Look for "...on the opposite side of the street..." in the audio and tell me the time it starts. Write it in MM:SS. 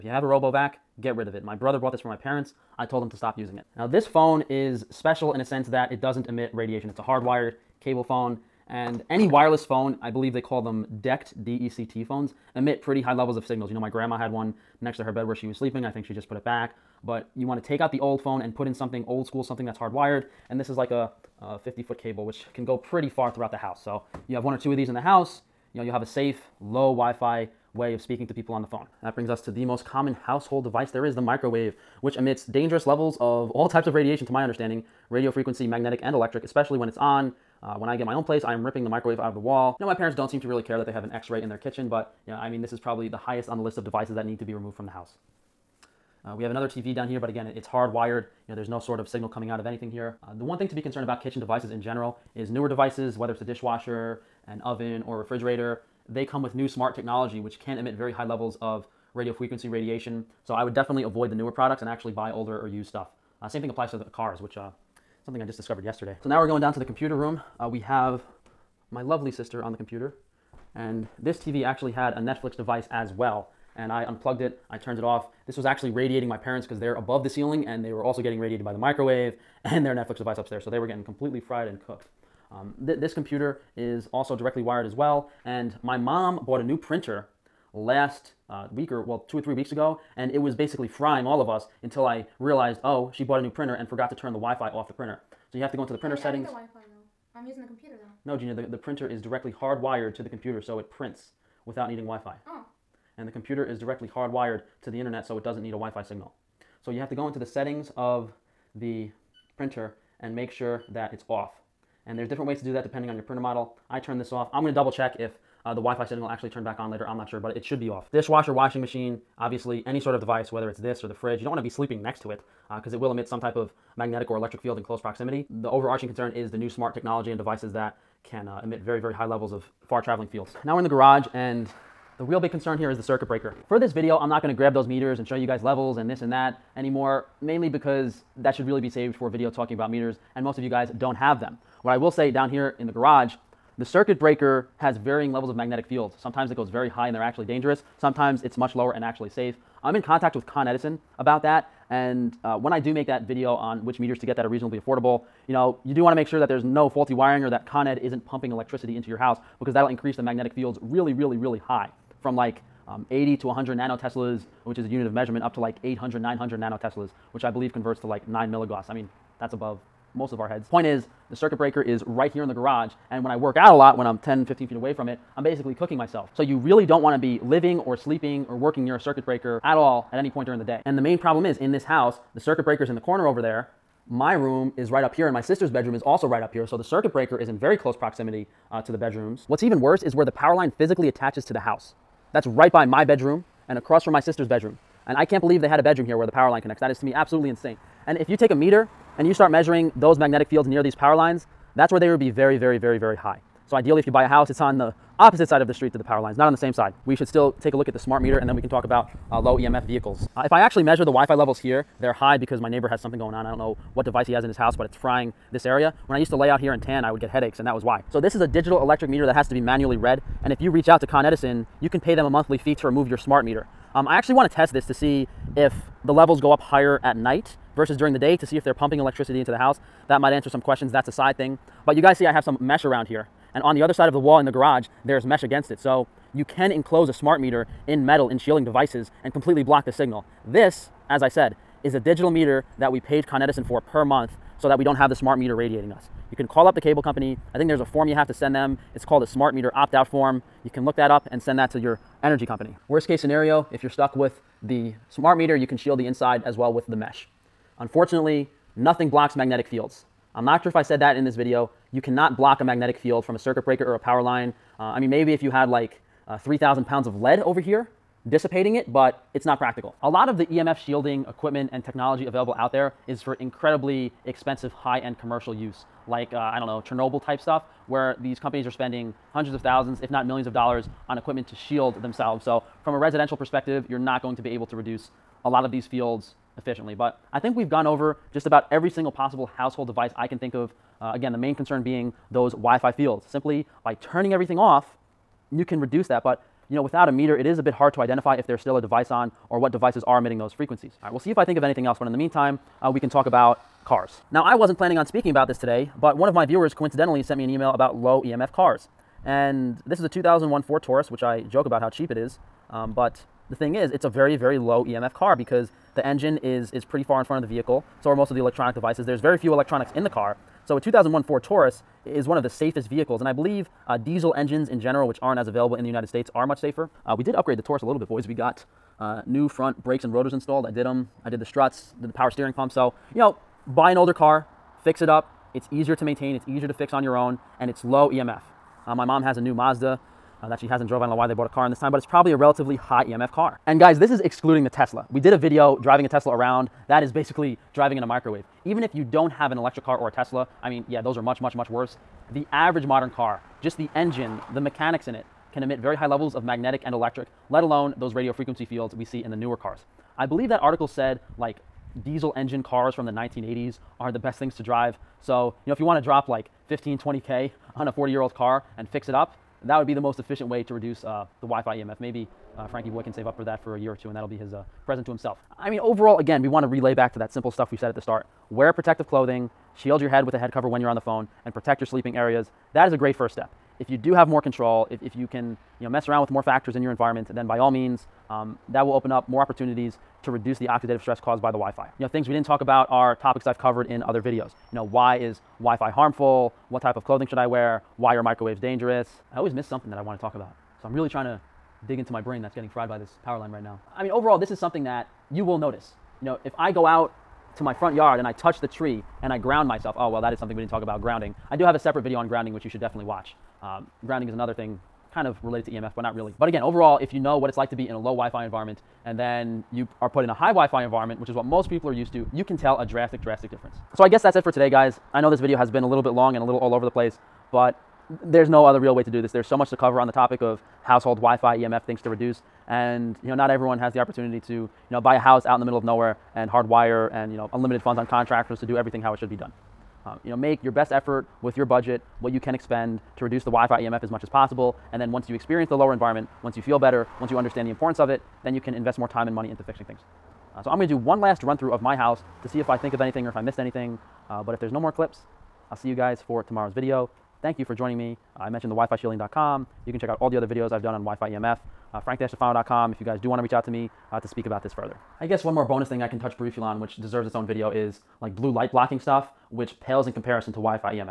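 03:24.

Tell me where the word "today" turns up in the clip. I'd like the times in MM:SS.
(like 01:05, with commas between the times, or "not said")
05:05, 07:04.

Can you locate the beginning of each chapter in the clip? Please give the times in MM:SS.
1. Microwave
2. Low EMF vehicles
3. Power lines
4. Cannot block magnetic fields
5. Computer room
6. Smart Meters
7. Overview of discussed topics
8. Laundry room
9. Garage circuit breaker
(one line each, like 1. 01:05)
1. 00:28
2. 05:01
3. 03:08
4. 04:17
5. 01:06
6. 03:26
7. 06:15
8. 01:57
9. 02:10.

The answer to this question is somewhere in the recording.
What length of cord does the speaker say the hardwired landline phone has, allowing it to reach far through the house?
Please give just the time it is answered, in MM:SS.
00:21.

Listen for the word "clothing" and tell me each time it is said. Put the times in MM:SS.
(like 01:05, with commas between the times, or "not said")
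06:19, 06:37.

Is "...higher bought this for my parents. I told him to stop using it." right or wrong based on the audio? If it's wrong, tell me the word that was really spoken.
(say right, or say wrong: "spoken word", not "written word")
wrong: "brother", not "higher".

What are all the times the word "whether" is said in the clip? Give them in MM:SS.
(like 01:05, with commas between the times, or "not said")
00:53, 02:00.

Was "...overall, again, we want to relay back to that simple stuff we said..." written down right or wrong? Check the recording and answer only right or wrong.
right.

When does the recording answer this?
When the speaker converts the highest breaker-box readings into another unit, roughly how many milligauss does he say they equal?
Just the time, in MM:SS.
02:48.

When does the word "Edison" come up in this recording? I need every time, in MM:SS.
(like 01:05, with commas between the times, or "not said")
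02:30, 03:41, 04:03.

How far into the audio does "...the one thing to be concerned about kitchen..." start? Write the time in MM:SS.
00:50.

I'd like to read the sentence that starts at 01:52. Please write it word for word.
And there's different ways to do that depending on your printer model.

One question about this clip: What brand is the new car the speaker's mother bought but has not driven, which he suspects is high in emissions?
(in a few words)
Mazda.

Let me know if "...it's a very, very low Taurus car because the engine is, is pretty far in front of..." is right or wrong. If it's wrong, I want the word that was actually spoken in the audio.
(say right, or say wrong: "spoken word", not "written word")
wrong: "EMF", not "Taurus".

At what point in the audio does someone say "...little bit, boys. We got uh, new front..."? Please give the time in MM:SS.
05:27.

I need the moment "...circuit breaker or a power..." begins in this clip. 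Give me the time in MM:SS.
04:23.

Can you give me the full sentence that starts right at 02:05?
The overarching concern is the new smart technology and devices that can uh, emit very, very high levels of far traveling fields.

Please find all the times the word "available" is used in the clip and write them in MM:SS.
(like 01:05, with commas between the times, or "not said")
04:32, 05:25.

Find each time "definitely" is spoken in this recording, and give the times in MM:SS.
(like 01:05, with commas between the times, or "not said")
01:00, 06:52.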